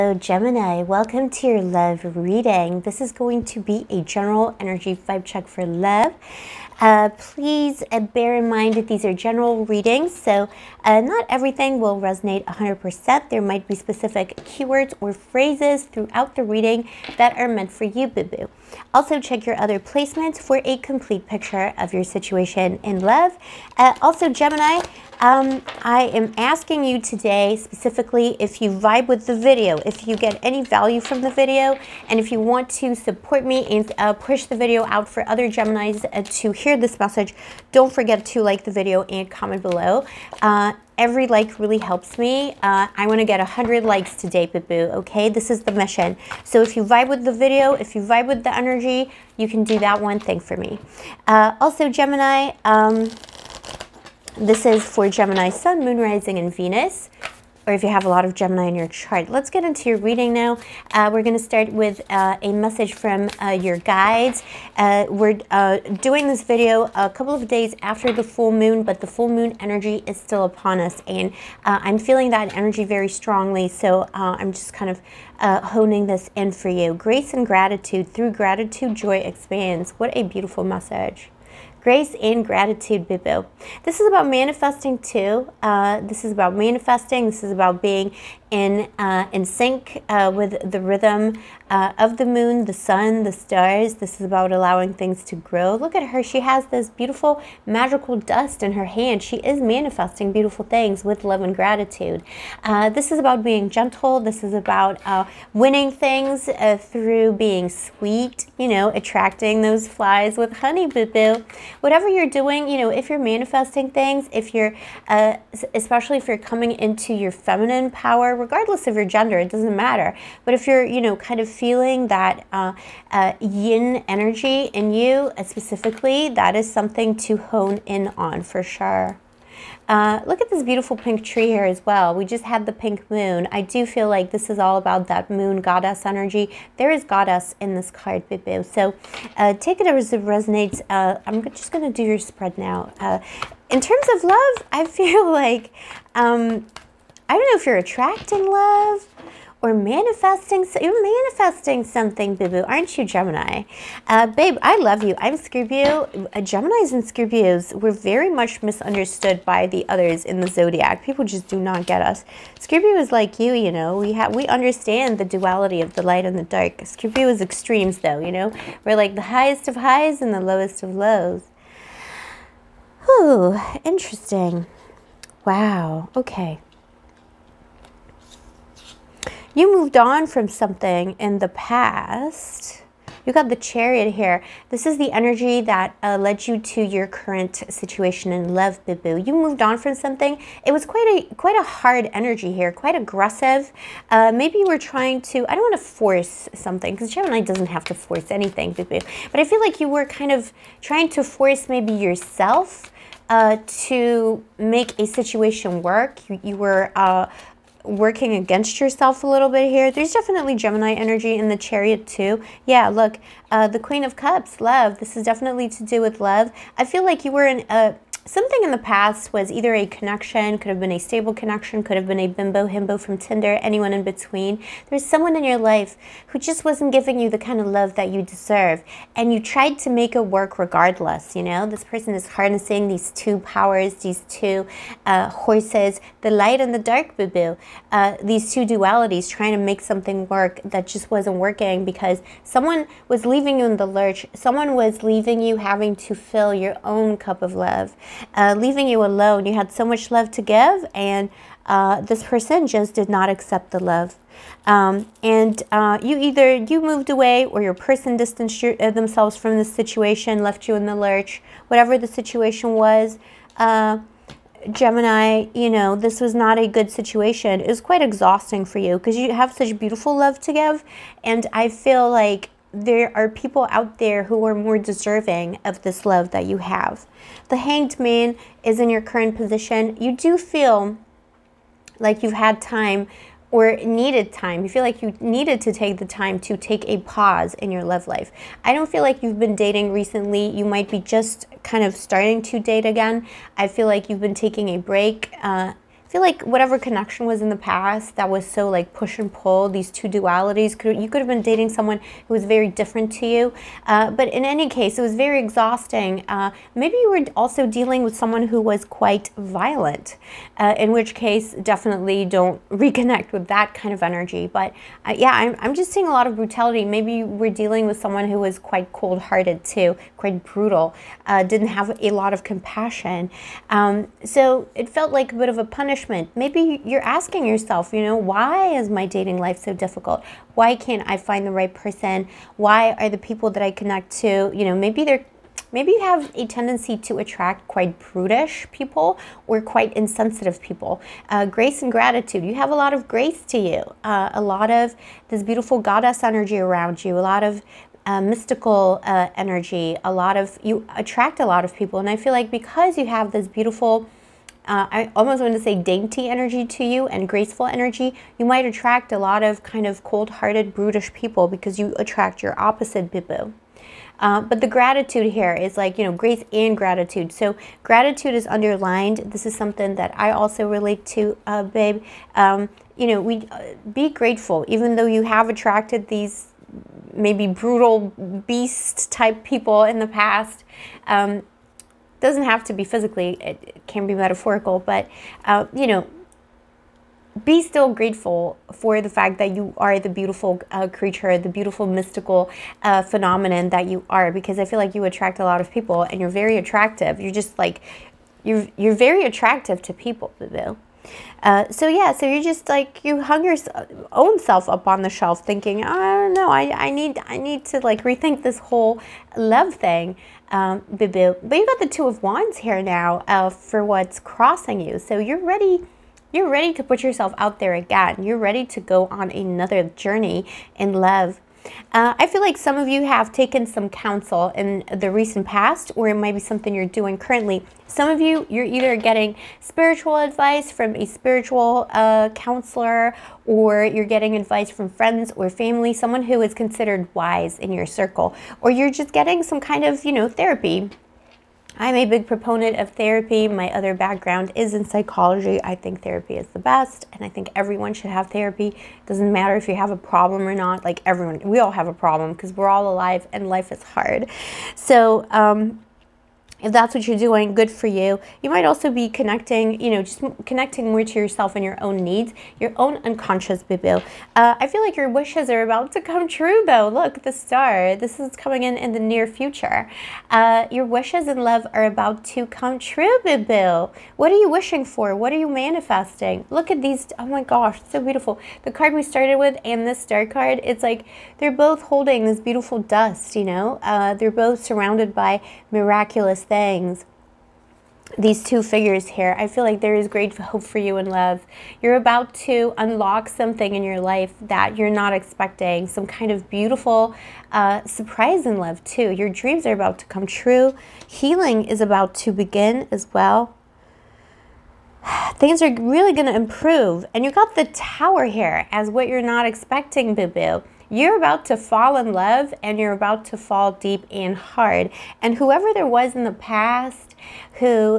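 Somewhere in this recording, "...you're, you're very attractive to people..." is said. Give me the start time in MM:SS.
06:38.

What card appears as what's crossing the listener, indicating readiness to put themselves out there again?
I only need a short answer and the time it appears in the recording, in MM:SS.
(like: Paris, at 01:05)
Two of Wands, at 06:51.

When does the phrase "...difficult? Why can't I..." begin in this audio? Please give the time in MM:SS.
05:29.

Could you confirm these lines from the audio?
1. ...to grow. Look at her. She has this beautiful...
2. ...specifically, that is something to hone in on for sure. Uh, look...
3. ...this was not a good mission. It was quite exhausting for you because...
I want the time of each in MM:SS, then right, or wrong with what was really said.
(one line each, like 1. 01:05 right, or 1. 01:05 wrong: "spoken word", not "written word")
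1. 01:35 right
2. 02:05 right
3. 04:25 wrong: "situation", not "mission".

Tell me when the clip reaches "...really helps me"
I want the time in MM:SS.
00:41.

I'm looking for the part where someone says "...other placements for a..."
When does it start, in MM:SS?
00:19.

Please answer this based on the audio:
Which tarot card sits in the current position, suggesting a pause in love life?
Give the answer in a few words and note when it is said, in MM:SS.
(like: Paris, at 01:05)
The Hanged Man, at 04:37.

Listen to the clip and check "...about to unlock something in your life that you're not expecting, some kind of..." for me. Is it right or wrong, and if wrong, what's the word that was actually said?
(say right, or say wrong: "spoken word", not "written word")
right.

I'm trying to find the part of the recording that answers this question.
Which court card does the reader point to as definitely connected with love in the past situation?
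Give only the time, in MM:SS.
03:33.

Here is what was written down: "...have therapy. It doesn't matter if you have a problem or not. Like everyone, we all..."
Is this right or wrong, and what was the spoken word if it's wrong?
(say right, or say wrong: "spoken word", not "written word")
right.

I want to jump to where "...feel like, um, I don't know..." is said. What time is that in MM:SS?
02:24.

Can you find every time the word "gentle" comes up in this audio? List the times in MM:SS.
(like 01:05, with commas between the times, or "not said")
01:43.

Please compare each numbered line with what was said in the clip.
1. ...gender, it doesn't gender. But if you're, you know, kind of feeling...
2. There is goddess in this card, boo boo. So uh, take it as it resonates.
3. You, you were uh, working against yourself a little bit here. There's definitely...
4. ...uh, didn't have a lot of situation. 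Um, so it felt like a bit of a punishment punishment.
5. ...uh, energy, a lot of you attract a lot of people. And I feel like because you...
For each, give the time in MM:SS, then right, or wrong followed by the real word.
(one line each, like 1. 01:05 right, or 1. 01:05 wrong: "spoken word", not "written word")
1. 01:59 wrong: "matter", not "gender"
2. 02:16 right
3. 03:26 right
4. 05:21 wrong: "compassion", not "situation"
5. 05:49 right.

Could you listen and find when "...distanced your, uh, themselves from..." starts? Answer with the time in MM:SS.
04:18.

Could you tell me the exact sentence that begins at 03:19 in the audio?
But I feel like you were kind of trying to force maybe yourself.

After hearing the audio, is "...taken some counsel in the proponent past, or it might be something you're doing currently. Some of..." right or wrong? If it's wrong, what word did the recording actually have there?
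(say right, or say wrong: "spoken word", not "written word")
wrong: "recent", not "proponent".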